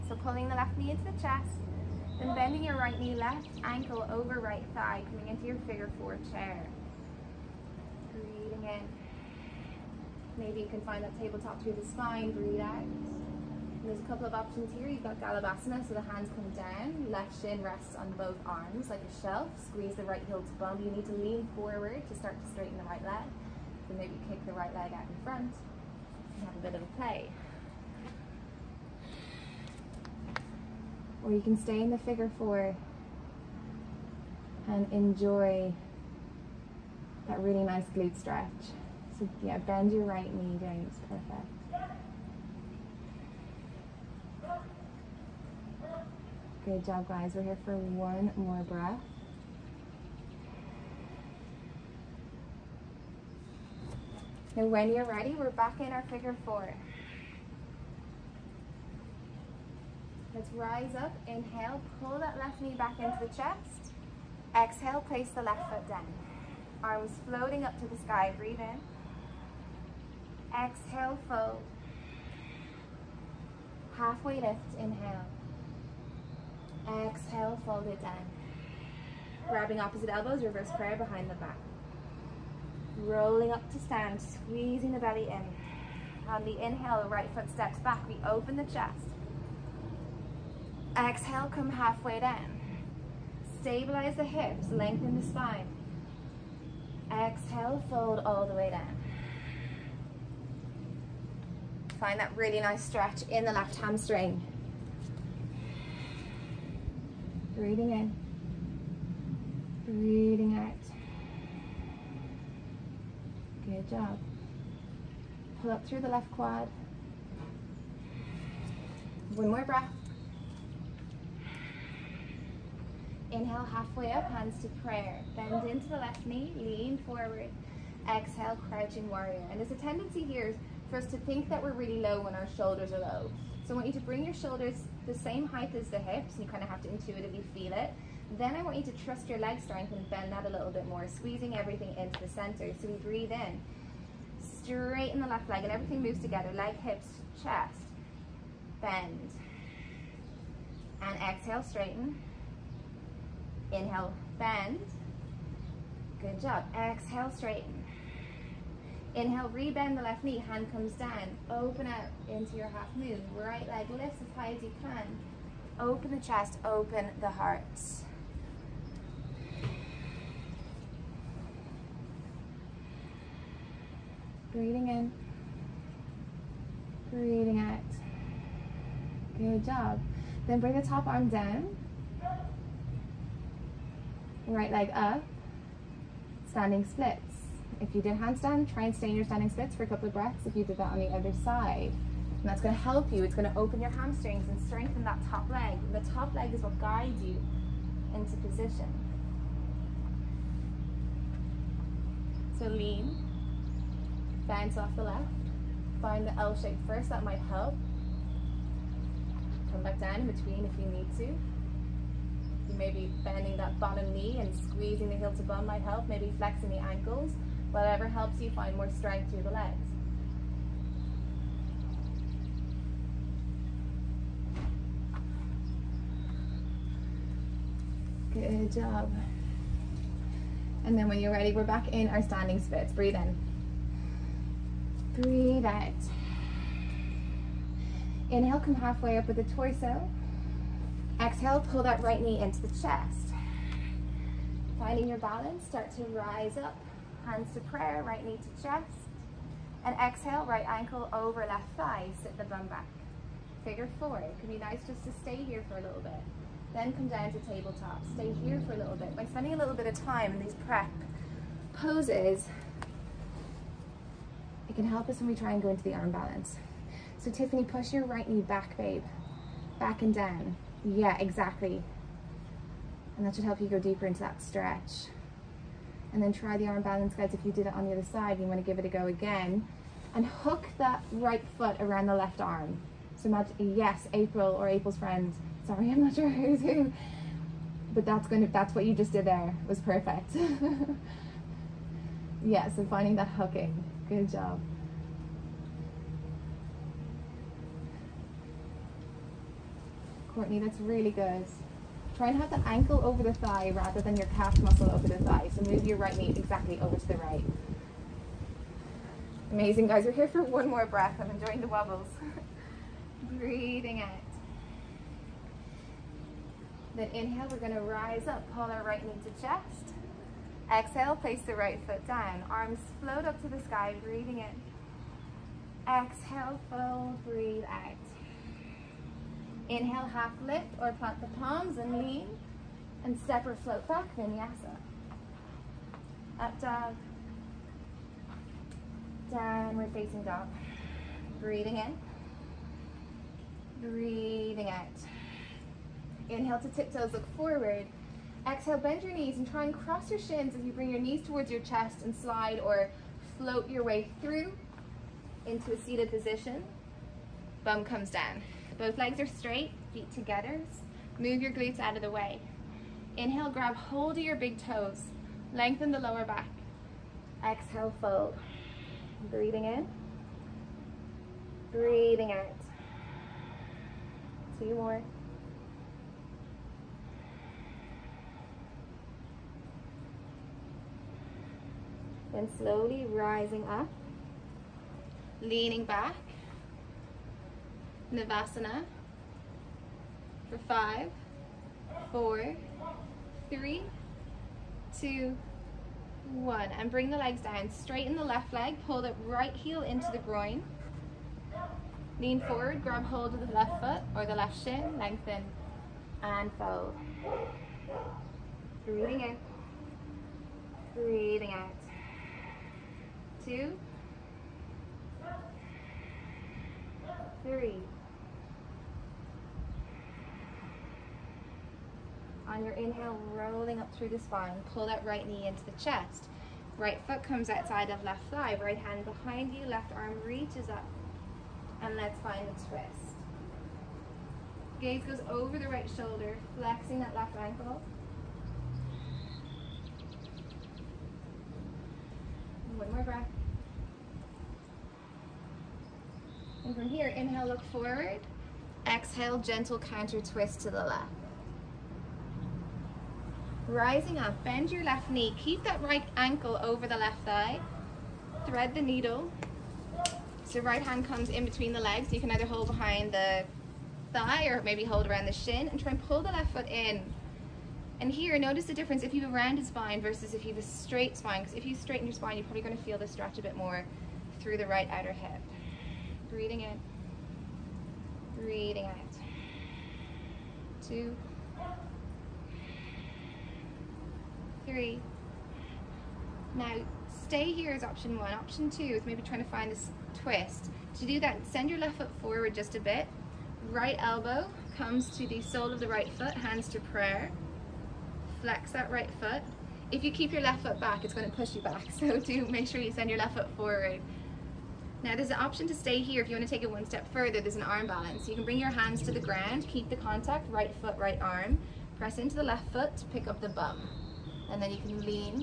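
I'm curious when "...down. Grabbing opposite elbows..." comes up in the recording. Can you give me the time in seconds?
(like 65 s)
78 s.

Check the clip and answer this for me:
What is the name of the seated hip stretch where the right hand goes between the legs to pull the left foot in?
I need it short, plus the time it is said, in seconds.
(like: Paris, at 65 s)
Thread the needle, at 458 s.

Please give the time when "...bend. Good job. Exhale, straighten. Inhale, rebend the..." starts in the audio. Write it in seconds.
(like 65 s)
154 s.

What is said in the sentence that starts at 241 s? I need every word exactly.
Exhale, pull that right knee into the chest.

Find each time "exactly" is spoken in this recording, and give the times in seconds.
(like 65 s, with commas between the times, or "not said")
271 s, 306 s.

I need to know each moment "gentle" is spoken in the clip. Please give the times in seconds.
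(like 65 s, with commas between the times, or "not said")
449 s.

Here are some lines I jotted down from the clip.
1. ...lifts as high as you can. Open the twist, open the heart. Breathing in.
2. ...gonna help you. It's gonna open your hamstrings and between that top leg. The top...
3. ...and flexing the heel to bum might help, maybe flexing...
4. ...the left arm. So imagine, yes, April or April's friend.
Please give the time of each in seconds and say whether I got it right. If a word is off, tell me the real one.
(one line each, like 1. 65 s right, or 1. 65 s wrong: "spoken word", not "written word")
1. 163 s wrong: "chest", not "twist"
2. 192 s wrong: "strengthen", not "between"
3. 214 s wrong: "squeezing", not "flexing"
4. 282 s right.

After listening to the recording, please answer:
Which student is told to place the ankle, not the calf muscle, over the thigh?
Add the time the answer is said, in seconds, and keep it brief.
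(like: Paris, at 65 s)
Courtney, at 300 s.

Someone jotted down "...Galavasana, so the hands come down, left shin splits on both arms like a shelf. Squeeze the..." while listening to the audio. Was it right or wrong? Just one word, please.
wrong.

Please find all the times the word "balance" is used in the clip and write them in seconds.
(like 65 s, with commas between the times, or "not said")
245 s, 266 s, 276 s, 507 s.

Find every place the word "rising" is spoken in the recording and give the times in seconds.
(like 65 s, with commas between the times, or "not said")
383 s, 453 s.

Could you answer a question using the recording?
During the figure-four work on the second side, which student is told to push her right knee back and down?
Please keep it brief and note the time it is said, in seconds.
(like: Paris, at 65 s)
Tiffany, at 267 s.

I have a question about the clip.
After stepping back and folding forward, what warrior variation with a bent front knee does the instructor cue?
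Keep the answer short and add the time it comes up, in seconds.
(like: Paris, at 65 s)
crouching warrior, at 128 s.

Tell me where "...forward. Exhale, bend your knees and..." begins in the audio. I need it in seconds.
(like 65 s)
347 s.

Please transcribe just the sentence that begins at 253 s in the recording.
Figure four, it can be nice just to stay here for a little bit.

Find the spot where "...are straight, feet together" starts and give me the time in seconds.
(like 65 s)
359 s.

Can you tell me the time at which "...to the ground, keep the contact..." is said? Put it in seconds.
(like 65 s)
509 s.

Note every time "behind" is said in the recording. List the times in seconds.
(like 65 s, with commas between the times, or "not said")
80 s, 429 s, 462 s.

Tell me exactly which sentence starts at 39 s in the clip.
So yeah, bend your right knee, down.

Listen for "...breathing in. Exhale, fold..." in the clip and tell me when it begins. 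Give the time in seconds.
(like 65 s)
324 s.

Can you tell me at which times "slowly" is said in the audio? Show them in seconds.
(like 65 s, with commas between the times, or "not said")
382 s.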